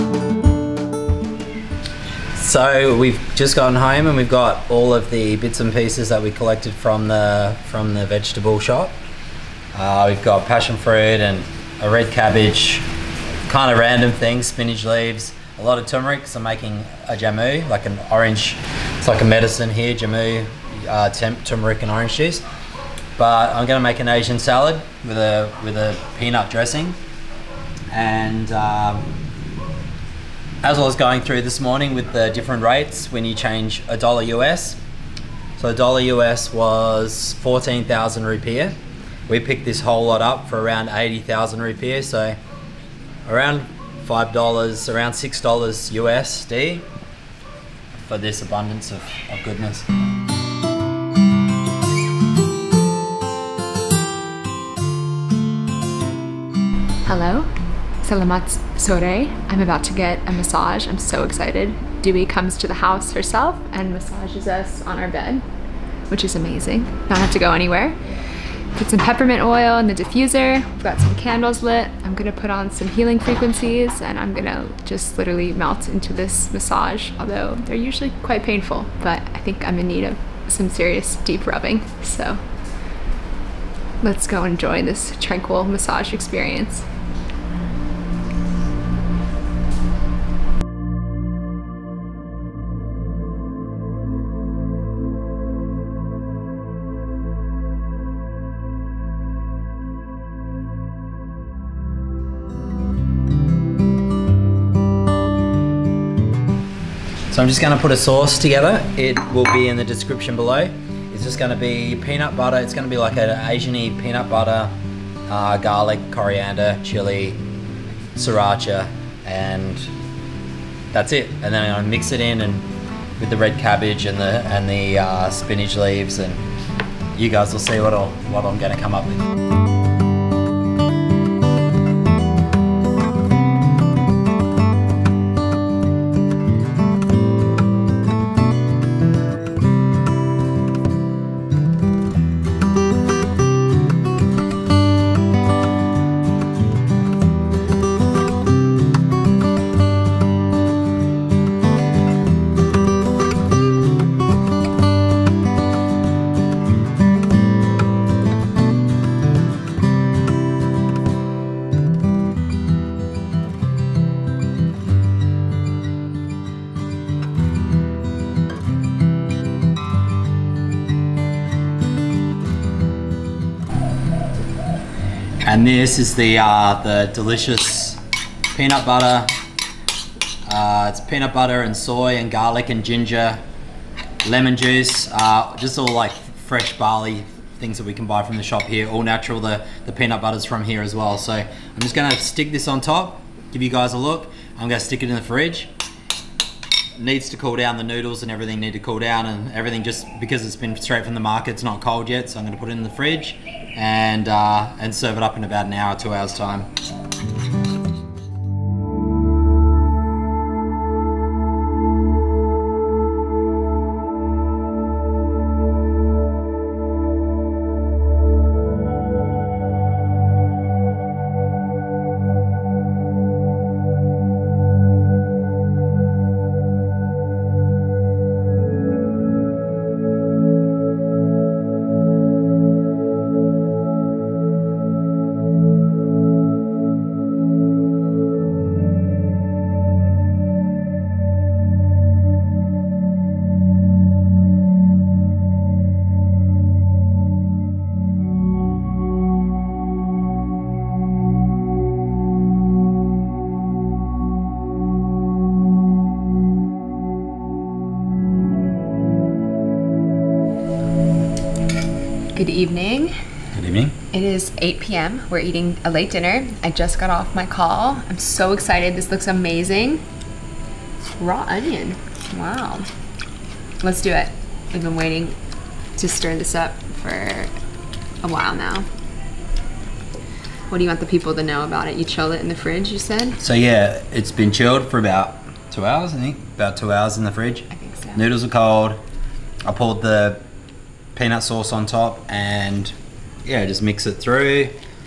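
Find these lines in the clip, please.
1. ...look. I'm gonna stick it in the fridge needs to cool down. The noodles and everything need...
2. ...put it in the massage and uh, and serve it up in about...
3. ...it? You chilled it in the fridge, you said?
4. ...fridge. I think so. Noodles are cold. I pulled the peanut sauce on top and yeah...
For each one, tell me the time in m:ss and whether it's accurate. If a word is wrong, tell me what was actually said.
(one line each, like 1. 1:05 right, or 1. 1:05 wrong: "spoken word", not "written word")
1. 3:13 right
2. 3:22 wrong: "fridge", not "massage"
3. 4:41 right
4. 4:47 right.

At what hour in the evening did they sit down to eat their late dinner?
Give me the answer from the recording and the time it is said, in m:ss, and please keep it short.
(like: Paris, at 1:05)
8 p.m., at 4:24.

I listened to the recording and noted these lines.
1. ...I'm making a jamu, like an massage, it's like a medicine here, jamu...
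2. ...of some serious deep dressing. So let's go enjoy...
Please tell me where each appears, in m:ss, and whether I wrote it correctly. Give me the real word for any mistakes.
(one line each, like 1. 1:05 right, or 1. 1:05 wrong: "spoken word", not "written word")
1. 0:16 wrong: "orange", not "massage"
2. 1:20 wrong: "rubbing", not "dressing".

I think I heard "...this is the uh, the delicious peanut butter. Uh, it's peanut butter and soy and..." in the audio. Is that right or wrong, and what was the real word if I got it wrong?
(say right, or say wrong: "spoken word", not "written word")
right.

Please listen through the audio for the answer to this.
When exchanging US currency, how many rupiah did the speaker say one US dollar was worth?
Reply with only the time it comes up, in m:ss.
0:37.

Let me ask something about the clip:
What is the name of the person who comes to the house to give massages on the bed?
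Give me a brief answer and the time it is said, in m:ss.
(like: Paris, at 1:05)
Dewey, at 1:02.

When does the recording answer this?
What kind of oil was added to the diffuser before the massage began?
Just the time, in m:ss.
1:09.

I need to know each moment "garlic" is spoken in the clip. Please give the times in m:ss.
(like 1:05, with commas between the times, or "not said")
1:55, 3:02.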